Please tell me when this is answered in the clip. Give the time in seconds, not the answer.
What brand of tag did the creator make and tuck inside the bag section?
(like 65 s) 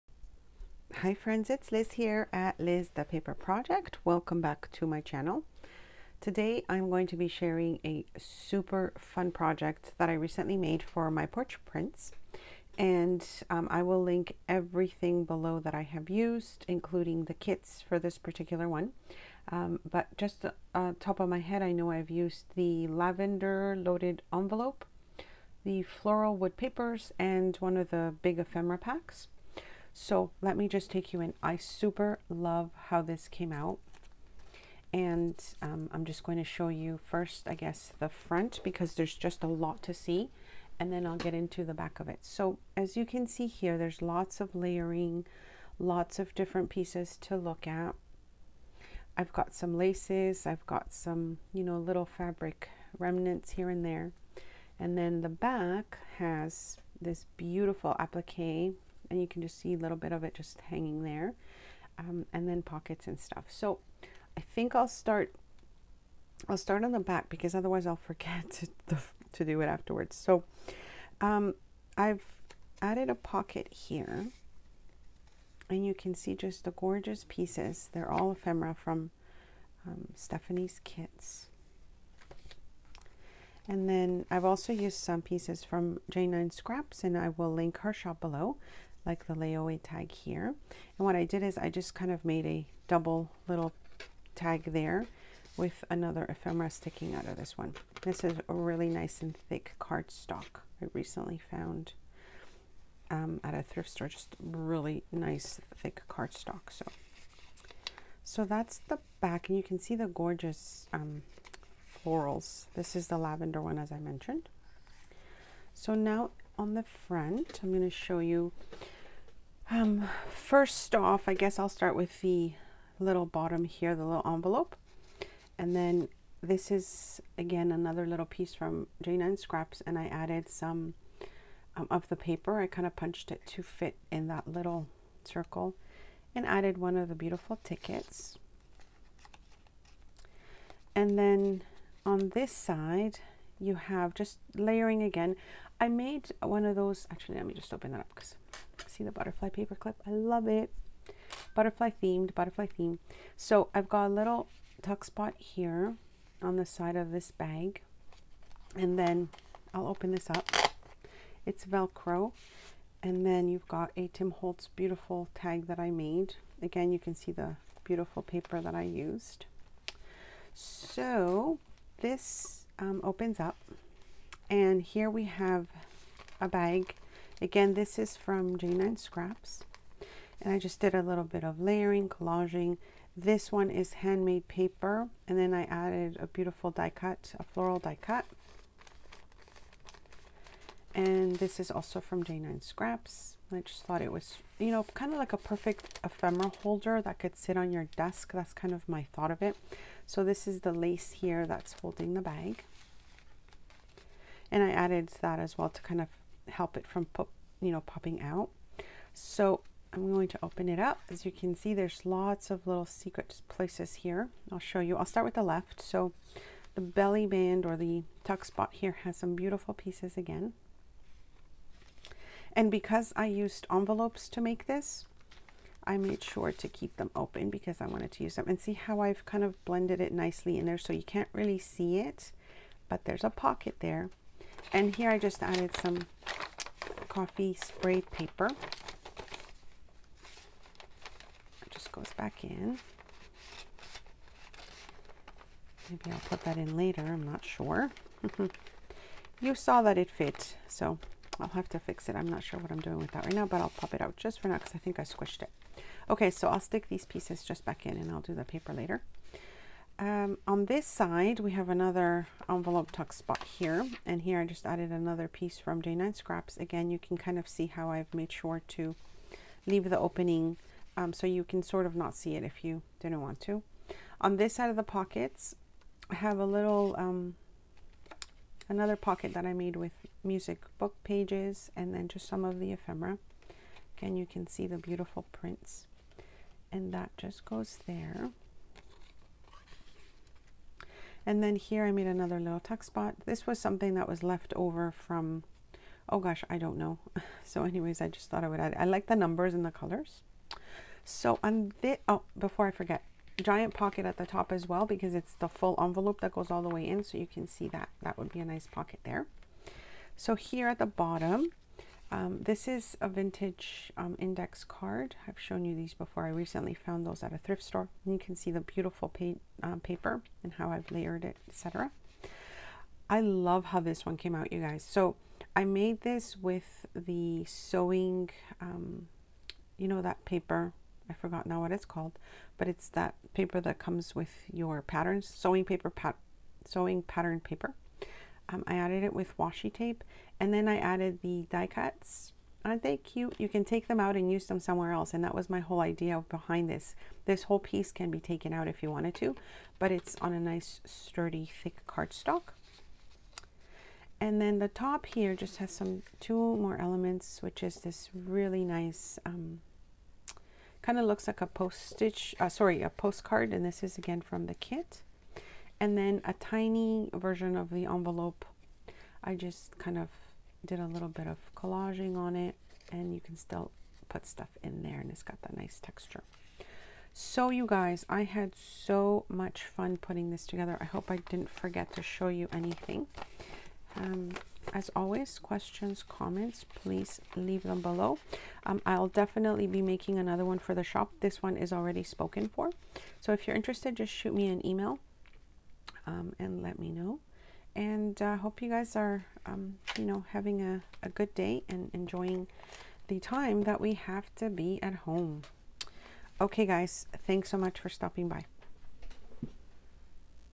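164 s.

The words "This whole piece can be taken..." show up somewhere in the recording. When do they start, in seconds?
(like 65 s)
347 s.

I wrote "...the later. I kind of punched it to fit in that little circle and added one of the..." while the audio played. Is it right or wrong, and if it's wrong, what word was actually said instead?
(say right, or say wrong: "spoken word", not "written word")
wrong: "paper", not "later".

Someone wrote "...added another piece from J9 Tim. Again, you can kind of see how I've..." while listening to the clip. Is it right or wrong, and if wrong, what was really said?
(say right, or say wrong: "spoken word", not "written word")
wrong: "Scraps", not "Tim".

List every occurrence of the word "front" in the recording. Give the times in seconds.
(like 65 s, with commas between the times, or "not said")
38 s, 116 s.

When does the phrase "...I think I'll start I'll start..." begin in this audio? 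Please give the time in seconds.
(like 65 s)
64 s.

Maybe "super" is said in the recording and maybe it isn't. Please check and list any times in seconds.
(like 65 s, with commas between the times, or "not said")
8 s, 31 s.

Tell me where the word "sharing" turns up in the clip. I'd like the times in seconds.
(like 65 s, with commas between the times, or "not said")
7 s.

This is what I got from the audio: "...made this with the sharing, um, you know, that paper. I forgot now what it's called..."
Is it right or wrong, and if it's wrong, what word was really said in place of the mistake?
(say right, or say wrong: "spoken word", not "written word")
wrong: "sewing", not "sharing".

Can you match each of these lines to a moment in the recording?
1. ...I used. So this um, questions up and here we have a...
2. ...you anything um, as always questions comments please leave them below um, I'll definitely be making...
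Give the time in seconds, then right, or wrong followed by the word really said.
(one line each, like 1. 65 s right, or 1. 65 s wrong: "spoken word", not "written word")
1. 168 s wrong: "opens", not "questions"
2. 382 s right.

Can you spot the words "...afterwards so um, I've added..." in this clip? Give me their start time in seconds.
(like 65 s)
69 s.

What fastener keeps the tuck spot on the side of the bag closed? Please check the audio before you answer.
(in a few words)
Velcro.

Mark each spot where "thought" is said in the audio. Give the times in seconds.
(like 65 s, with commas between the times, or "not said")
193 s, 199 s, 298 s.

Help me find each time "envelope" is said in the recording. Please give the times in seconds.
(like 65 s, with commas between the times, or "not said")
24 s, 124 s, 223 s, 262 s, 305 s, 367 s.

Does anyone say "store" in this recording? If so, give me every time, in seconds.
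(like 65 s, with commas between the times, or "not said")
103 s, 317 s.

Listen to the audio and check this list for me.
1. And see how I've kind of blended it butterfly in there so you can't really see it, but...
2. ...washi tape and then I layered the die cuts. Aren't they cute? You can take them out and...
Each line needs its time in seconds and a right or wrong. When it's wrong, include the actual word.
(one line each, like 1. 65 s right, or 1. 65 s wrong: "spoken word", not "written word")
1. 228 s wrong: "nicely", not "butterfly"
2. 339 s wrong: "added", not "layered".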